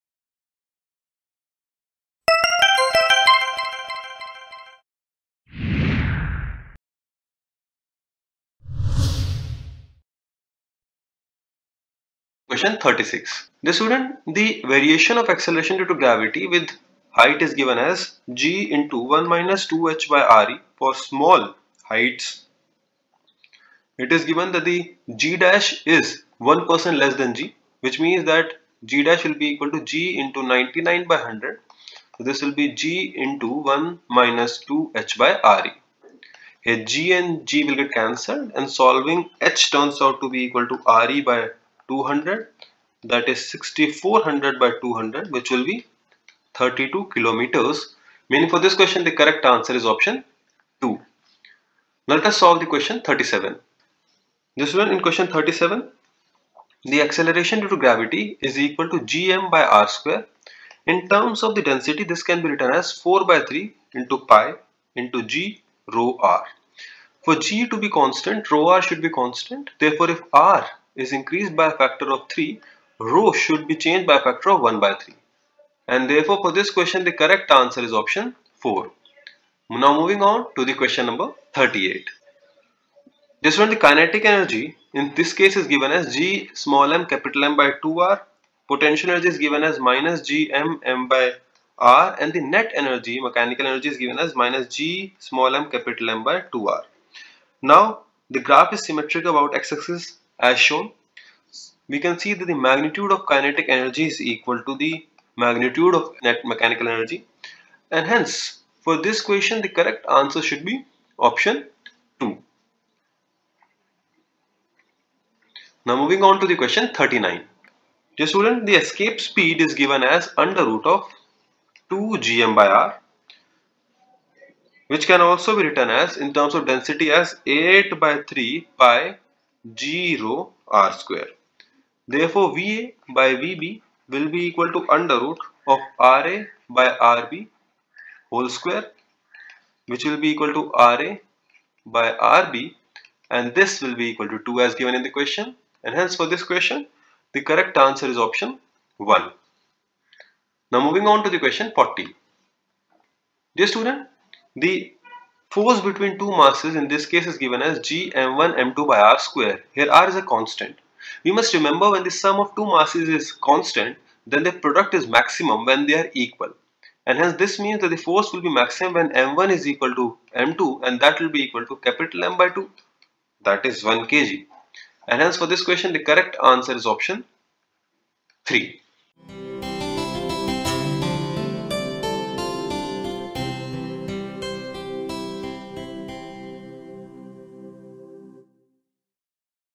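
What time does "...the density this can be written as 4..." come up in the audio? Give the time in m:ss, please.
1:01.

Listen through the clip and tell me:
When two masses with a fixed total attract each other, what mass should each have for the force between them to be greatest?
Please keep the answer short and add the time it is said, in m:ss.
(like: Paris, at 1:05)
1 kg, at 2:53.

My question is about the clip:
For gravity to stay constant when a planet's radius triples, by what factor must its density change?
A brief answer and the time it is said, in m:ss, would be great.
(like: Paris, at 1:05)
1/3, at 1:14.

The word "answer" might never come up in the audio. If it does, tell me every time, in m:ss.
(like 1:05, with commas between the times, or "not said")
0:49, 1:17, 1:50, 2:27, 2:56.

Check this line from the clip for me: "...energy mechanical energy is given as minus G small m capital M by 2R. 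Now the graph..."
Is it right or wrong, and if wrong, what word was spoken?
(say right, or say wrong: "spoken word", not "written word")
right.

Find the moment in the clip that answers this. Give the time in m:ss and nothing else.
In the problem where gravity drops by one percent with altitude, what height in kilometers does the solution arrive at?
0:46.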